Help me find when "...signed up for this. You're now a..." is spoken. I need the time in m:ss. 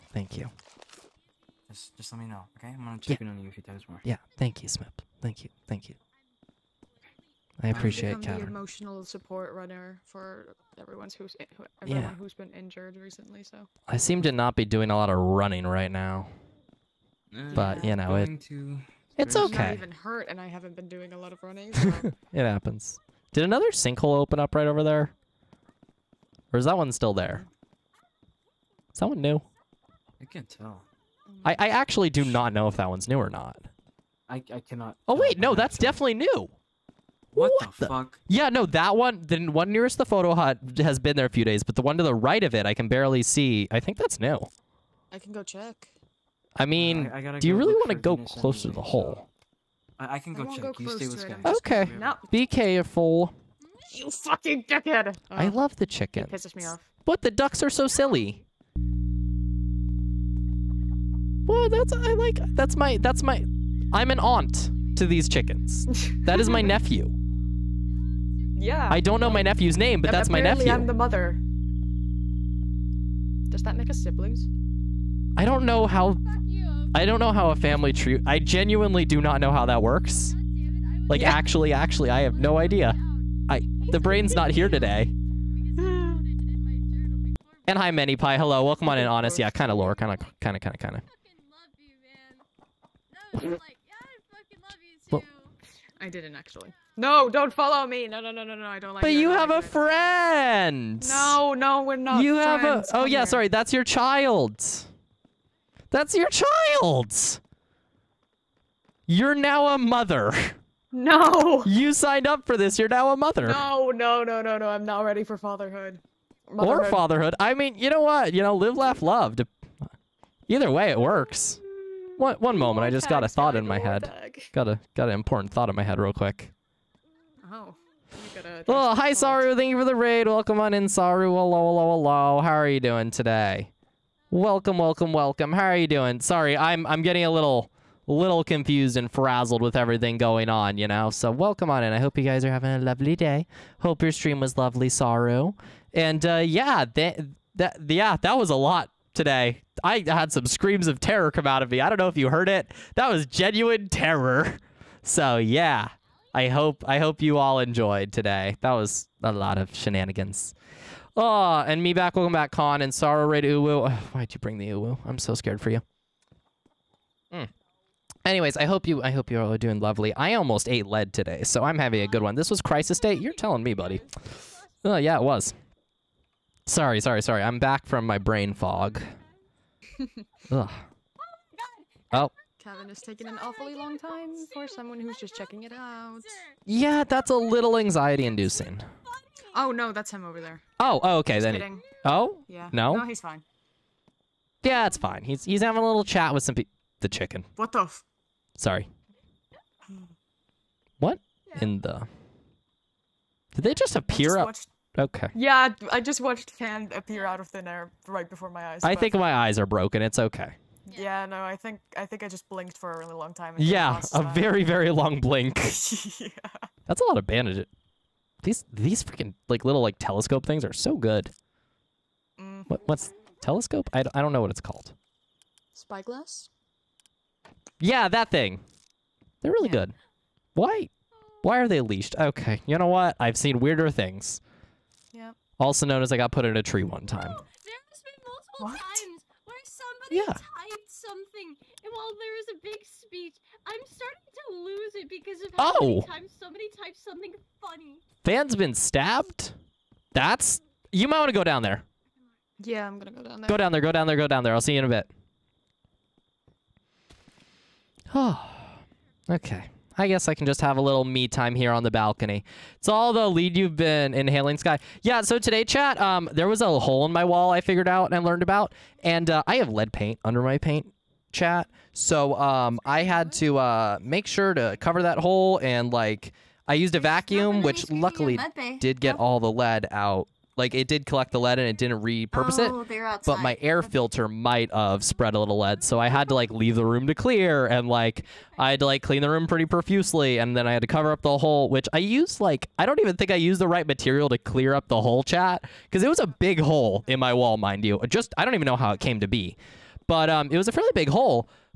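1:51.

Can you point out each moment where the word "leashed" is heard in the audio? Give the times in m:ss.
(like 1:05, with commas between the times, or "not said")
3:51.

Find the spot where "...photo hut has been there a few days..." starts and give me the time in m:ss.
0:40.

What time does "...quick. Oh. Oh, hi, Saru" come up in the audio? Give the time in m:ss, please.
2:06.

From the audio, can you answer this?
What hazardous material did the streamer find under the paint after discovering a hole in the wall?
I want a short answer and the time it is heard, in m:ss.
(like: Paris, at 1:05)
lead paint, at 4:29.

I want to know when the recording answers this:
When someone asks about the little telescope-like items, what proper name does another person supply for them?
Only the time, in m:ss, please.
3:45.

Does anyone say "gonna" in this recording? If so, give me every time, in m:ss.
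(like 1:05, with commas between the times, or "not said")
0:02, 4:12.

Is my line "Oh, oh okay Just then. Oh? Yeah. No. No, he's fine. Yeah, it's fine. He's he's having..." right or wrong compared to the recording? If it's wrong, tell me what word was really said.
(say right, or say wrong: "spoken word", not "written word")
right.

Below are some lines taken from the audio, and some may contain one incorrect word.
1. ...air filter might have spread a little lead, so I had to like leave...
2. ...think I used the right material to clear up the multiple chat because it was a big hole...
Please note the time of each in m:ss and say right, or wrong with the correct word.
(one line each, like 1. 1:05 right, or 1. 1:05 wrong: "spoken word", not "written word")
1. 4:43 right
2. 4:53 wrong: "whole", not "multiple".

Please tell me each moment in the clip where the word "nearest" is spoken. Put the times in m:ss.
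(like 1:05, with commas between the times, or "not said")
0:39.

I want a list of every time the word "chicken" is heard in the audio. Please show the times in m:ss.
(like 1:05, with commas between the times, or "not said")
0:55, 1:05, 3:17.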